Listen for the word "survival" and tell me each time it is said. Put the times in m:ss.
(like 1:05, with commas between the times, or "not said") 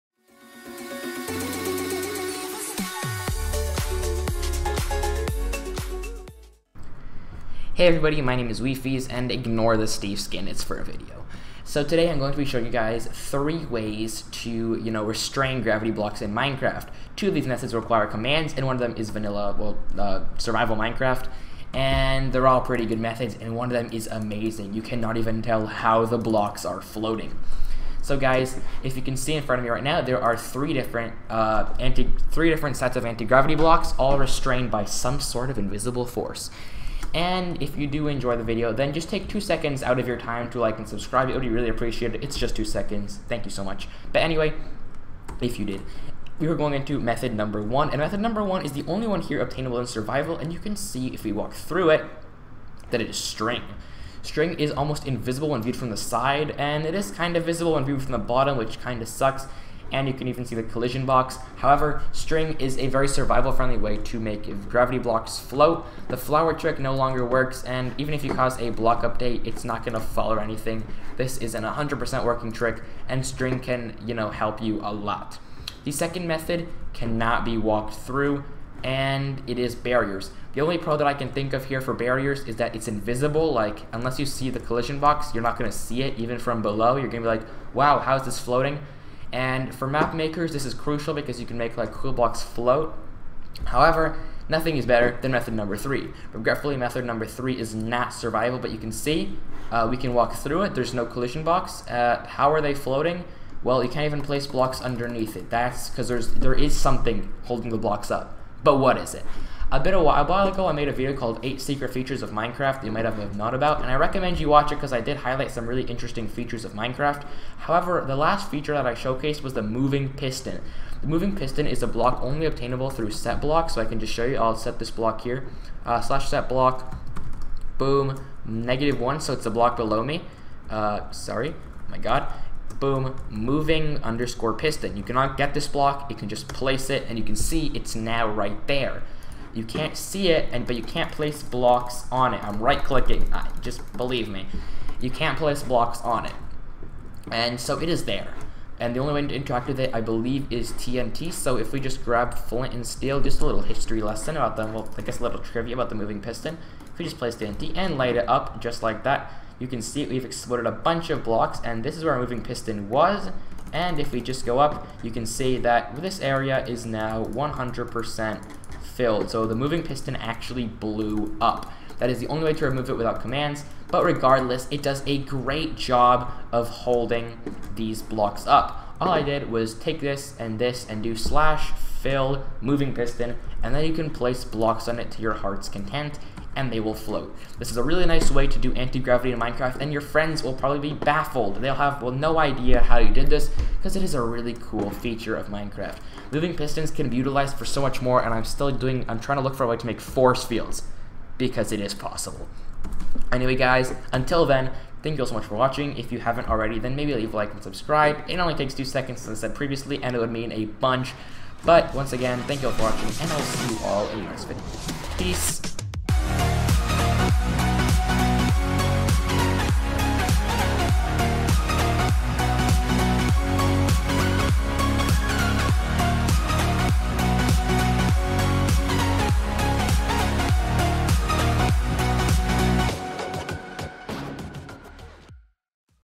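0:20, 0:49, 1:03, 1:38.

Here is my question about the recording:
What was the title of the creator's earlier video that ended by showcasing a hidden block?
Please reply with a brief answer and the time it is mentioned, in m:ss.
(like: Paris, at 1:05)
8 Secret Features of Minecraft, at 1:51.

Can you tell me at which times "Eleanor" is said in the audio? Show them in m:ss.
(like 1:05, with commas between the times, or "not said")
not said.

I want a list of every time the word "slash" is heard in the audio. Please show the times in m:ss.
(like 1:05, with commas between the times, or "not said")
2:06, 3:01.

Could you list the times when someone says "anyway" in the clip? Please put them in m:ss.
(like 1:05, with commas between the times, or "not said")
0:44, 3:23.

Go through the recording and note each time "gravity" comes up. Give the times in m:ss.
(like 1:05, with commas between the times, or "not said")
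0:15, 0:33, 1:04, 3:08.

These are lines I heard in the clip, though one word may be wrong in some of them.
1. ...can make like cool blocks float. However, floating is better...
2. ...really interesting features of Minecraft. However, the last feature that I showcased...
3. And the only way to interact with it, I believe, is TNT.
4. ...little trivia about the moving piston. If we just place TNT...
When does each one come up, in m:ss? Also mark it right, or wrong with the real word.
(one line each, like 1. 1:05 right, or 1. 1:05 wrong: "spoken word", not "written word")
1. 1:31 wrong: "nothing", not "floating"
2. 1:55 right
3. 2:28 right
4. 2:35 right.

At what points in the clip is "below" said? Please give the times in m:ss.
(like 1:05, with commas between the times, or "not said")
1:26, 2:09.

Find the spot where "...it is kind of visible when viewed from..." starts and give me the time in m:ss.
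0:56.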